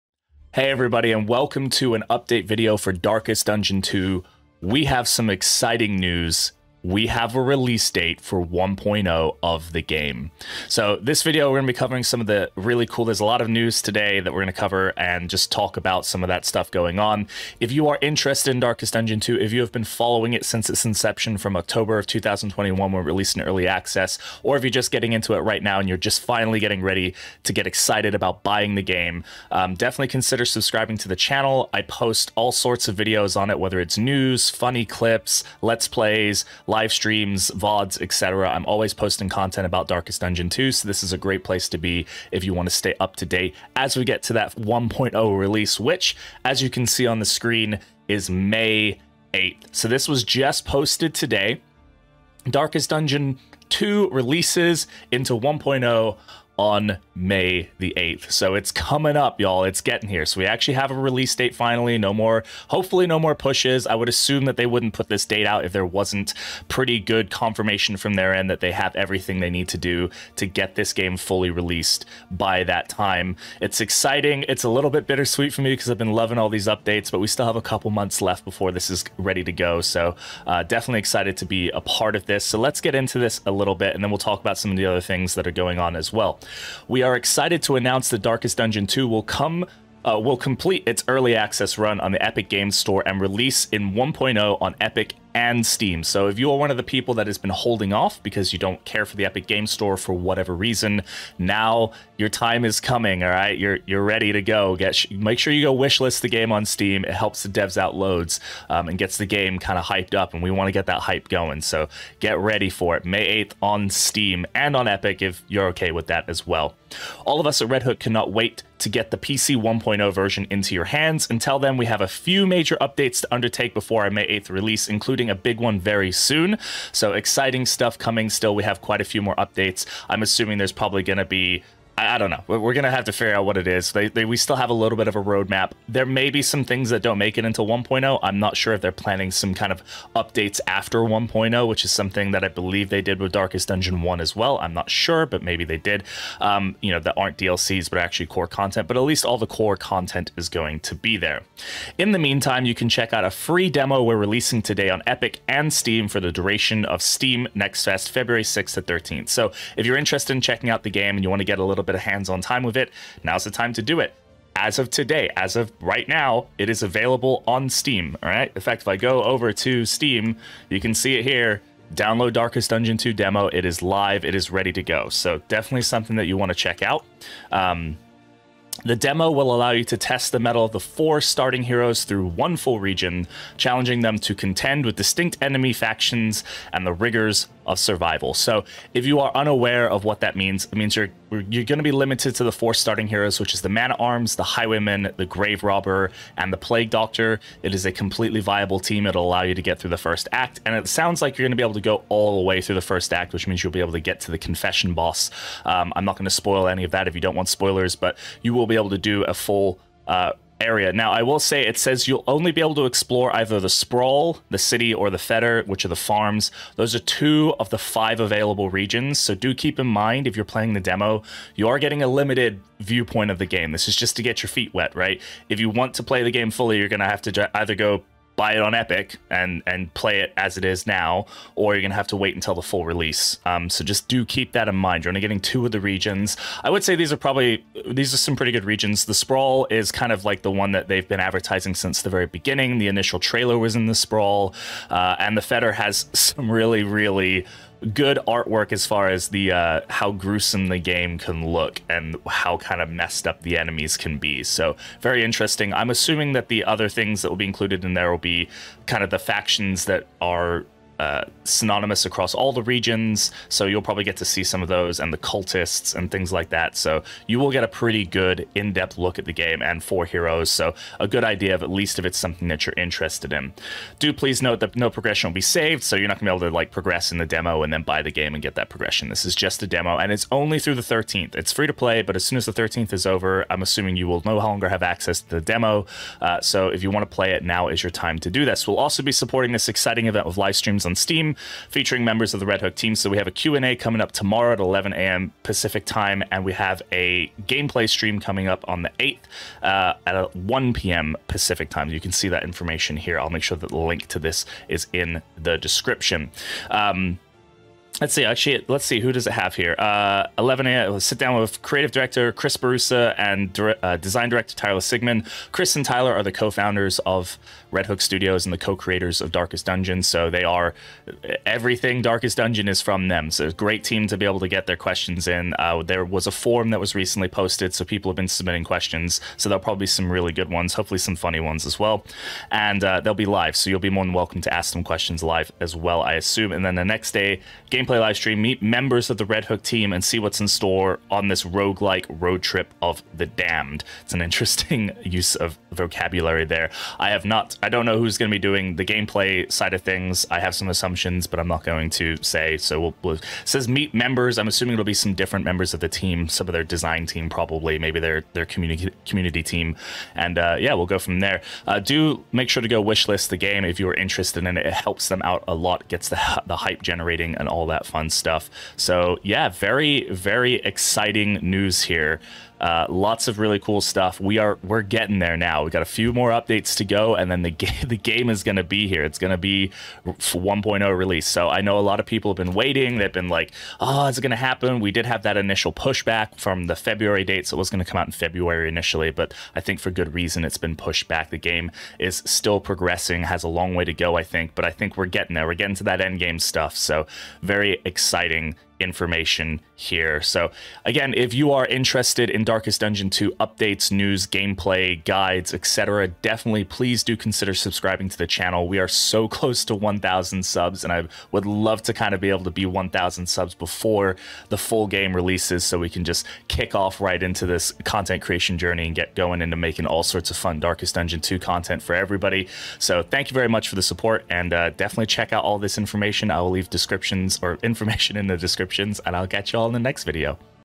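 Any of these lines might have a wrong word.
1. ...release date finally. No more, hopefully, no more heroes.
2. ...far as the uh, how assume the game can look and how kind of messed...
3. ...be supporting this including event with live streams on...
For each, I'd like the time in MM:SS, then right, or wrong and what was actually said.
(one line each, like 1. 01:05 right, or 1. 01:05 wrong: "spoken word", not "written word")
1. 01:00 wrong: "pushes", not "heroes"
2. 04:08 wrong: "gruesome", not "assume"
3. 04:49 wrong: "exciting", not "including".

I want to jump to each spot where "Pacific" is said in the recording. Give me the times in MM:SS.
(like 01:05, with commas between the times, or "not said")
04:55, 05:01.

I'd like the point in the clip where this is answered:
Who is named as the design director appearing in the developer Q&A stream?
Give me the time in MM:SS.
05:14.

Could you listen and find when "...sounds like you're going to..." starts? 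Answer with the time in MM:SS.
03:20.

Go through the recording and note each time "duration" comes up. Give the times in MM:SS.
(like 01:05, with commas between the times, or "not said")
02:36.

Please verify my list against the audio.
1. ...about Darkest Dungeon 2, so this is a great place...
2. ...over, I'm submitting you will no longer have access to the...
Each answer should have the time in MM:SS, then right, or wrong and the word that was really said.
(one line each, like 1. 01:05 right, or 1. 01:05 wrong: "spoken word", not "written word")
1. 00:39 right
2. 04:43 wrong: "assuming", not "submitting".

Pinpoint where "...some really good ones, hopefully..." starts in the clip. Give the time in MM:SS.
05:29.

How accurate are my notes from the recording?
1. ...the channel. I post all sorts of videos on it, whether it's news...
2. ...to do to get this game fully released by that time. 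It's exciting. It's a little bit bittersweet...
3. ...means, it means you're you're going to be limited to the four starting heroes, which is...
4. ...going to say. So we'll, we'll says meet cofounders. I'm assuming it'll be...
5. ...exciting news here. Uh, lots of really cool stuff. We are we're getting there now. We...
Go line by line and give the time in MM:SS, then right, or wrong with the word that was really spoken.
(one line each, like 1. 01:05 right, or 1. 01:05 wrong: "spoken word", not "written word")
1. 00:31 right
2. 01:09 right
3. 03:10 right
4. 05:51 wrong: "members", not "cofounders"
5. 06:10 right.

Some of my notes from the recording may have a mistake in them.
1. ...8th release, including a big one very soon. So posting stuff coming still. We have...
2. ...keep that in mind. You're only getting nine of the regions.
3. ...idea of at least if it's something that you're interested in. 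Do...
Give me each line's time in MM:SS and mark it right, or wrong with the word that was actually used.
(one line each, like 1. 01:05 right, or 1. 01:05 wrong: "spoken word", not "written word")
1. 02:04 wrong: "exciting", not "posting"
2. 03:54 wrong: "two", not "nine"
3. 04:31 right.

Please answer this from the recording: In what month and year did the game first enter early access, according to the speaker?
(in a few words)
October 2021.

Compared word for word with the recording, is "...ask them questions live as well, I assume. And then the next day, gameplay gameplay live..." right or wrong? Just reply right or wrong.
right.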